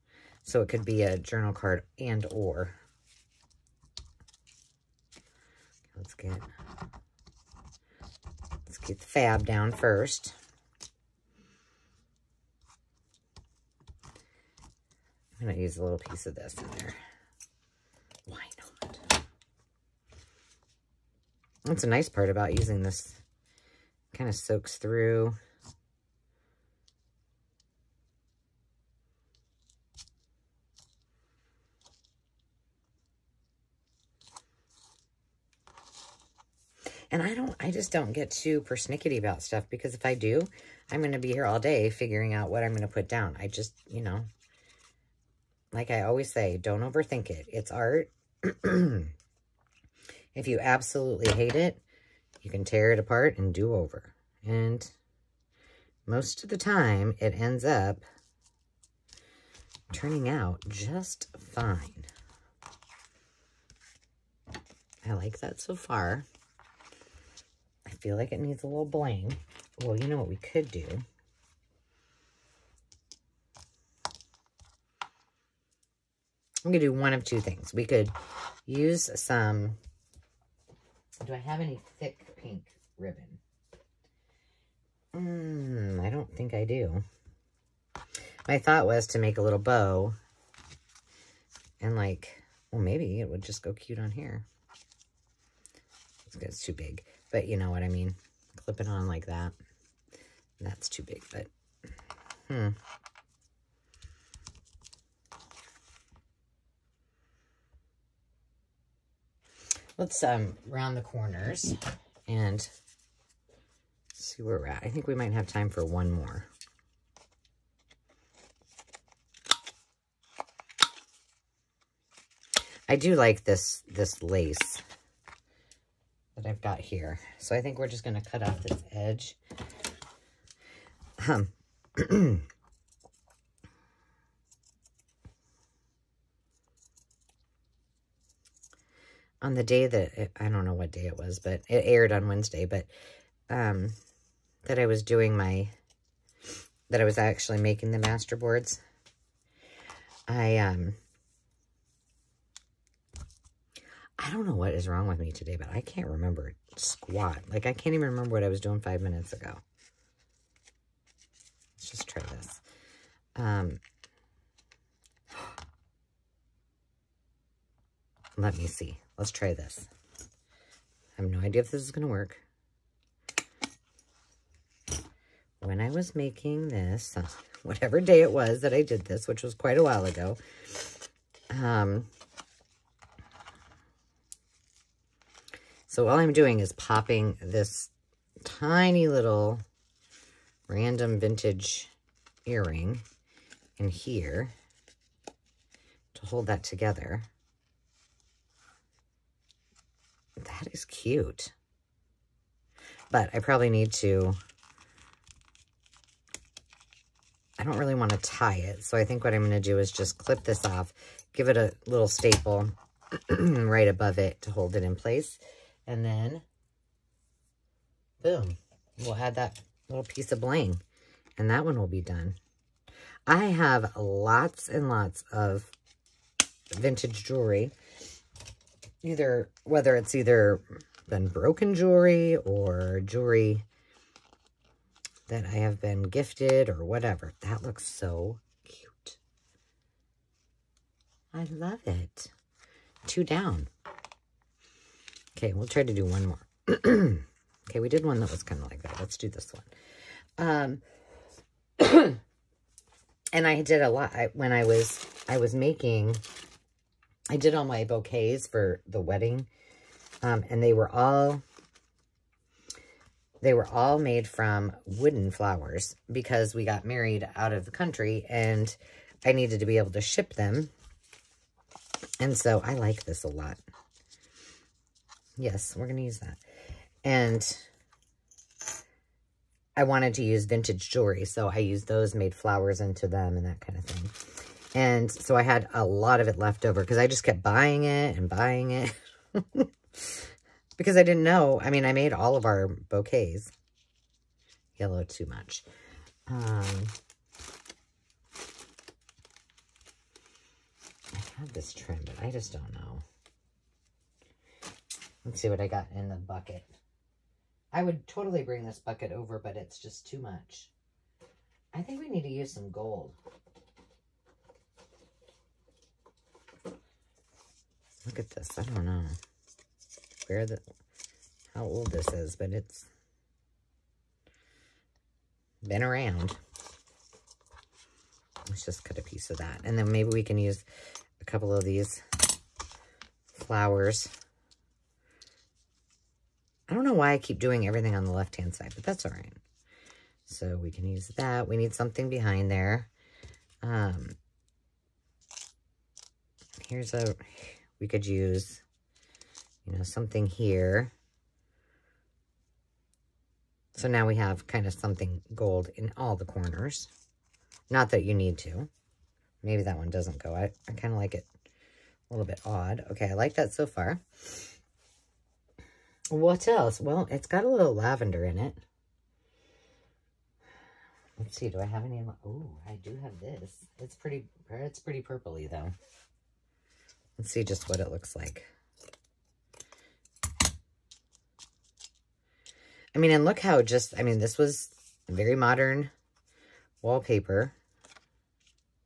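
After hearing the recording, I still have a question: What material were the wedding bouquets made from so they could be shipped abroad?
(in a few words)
Wooden flowers.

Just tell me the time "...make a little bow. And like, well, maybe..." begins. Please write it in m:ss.
1:29.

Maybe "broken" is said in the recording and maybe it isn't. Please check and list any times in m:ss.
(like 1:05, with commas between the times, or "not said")
3:51.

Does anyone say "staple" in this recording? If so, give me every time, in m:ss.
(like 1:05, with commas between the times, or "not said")
3:32.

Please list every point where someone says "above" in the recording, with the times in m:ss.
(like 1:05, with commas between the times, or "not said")
3:33.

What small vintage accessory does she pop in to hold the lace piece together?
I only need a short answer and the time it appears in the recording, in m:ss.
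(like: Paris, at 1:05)
Earring, at 3:12.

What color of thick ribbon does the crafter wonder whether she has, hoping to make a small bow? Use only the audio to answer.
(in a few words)
Pink.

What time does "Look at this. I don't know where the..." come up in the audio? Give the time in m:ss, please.
5:18.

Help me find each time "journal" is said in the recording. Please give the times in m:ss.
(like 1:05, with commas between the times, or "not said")
0:01.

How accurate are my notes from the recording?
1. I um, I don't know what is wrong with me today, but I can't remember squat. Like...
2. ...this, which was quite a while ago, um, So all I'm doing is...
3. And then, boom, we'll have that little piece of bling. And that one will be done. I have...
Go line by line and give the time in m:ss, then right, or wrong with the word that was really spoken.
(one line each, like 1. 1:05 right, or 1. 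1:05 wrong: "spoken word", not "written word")
1. 2:30 right
2. 2:59 right
3. 3:35 right.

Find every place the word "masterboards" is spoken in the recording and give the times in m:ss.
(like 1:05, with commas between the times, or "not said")
2:27.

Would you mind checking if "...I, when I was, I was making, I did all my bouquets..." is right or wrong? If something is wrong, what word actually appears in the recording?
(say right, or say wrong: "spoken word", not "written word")
right.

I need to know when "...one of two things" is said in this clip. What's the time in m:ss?
1:16.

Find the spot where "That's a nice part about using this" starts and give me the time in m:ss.
0:21.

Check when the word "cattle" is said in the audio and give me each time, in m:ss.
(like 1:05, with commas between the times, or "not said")
not said.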